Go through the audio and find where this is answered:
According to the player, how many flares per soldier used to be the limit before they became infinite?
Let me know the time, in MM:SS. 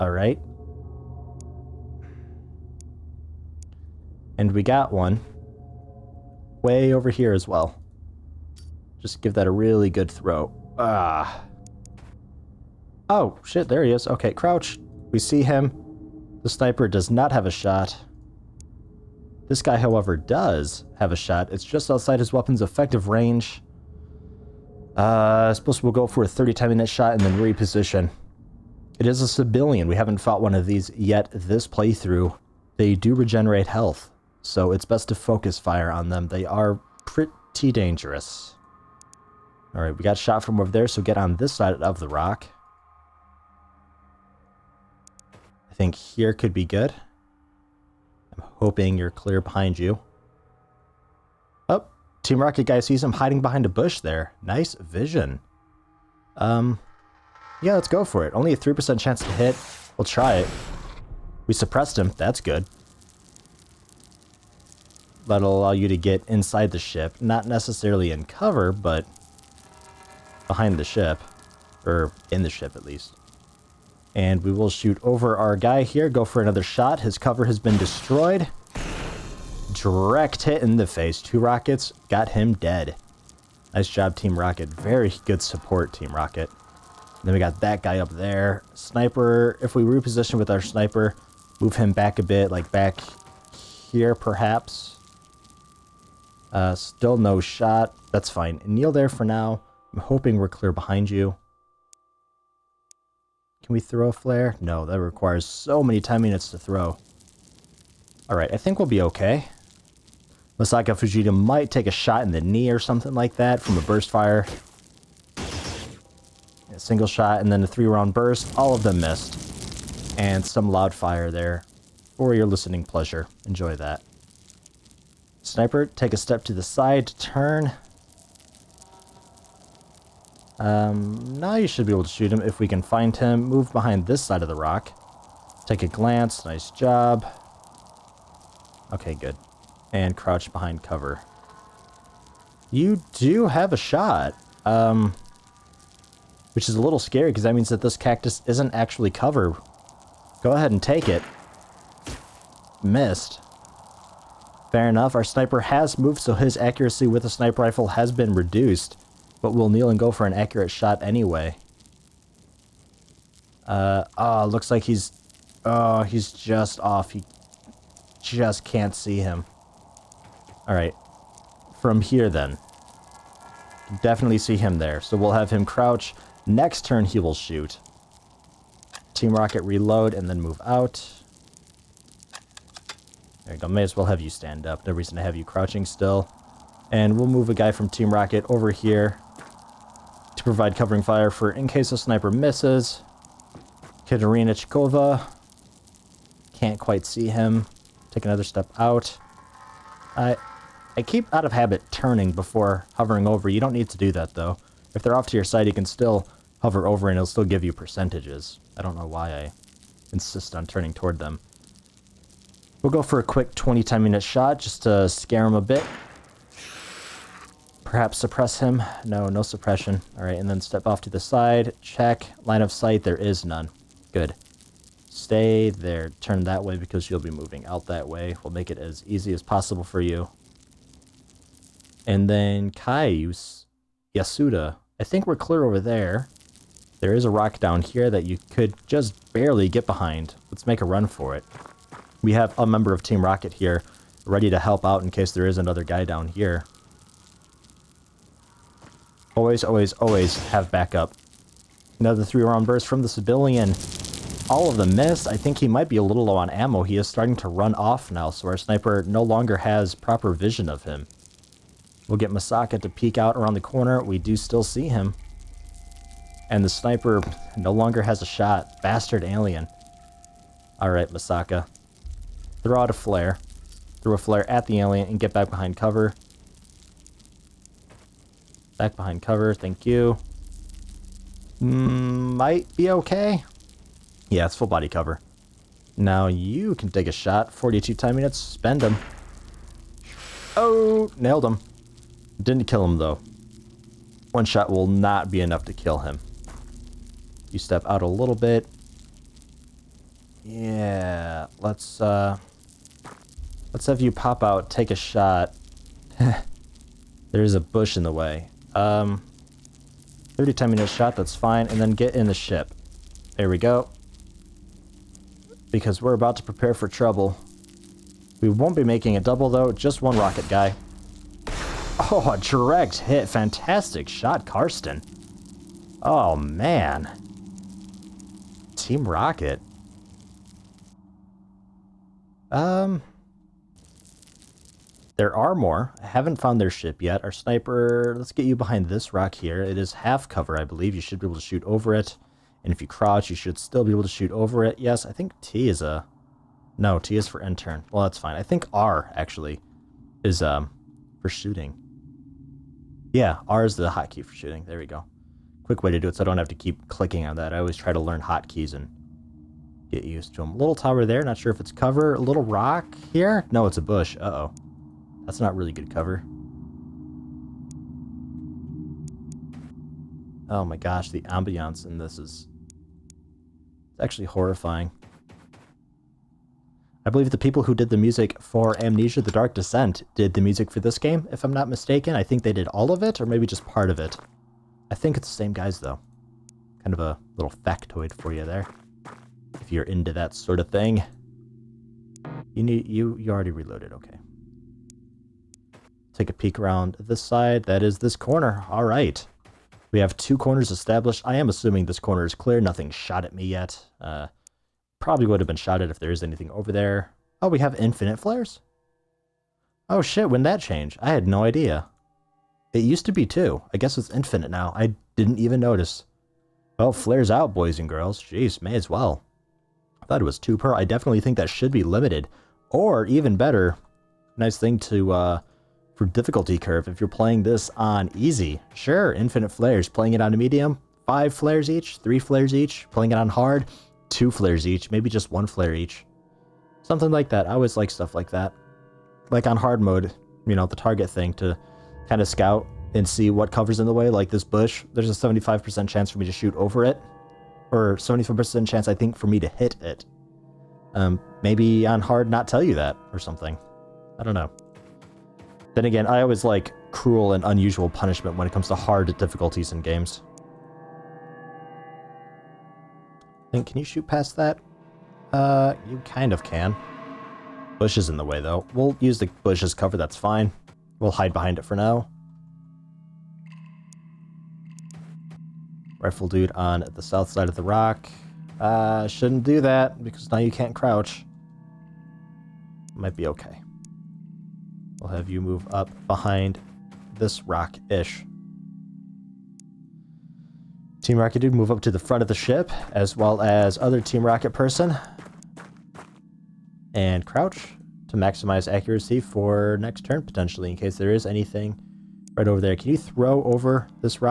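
06:52.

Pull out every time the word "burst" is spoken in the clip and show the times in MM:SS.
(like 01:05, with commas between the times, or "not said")
01:53, 01:58, 04:12.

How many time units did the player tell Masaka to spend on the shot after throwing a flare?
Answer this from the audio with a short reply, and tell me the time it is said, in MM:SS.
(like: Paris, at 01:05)
42, at 04:47.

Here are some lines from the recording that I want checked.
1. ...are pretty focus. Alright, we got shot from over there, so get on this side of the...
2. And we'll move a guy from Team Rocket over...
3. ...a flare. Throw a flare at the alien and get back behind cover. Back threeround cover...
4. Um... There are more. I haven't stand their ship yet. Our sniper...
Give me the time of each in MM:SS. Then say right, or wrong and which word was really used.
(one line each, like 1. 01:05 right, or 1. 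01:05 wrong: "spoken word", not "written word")
1. 00:36 wrong: "dangerous", not "focus"
2. 03:06 right
3. 04:32 wrong: "behind", not "threeround"
4. 05:32 wrong: "found", not "stand".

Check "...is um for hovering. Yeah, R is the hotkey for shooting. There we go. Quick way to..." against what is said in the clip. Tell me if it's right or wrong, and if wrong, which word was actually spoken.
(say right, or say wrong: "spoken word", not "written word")
wrong: "shooting", not "hovering".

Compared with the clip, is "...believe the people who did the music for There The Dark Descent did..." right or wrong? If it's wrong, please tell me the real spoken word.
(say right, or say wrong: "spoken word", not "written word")
wrong: "Amnesia", not "There".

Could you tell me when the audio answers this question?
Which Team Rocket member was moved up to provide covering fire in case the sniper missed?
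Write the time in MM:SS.
03:14.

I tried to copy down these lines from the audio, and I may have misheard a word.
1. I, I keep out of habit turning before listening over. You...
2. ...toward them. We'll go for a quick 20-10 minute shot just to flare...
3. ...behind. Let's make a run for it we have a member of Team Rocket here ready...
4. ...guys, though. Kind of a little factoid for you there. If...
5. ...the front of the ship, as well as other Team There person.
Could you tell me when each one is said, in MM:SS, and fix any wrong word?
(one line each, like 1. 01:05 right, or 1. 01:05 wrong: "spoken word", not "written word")
1. 03:20 wrong: "hovering", not "listening"
2. 03:30 wrong: "scare", not "flare"
3. 03:59 right
4. 06:25 right
5. 08:11 wrong: "Rocket", not "There".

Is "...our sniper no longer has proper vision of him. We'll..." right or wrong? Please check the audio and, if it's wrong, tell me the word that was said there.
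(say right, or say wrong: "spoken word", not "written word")
right.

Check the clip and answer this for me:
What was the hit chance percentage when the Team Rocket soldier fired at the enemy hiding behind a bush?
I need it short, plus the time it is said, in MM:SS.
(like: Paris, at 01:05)
3%, at 00:58.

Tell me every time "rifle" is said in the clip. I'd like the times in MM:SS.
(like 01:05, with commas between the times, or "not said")
02:37, 07:55.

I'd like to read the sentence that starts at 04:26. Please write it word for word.
And the sniper no longer has a shot.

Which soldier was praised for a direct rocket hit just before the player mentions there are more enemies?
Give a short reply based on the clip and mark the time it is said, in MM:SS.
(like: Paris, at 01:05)
Karsten, at 05:23.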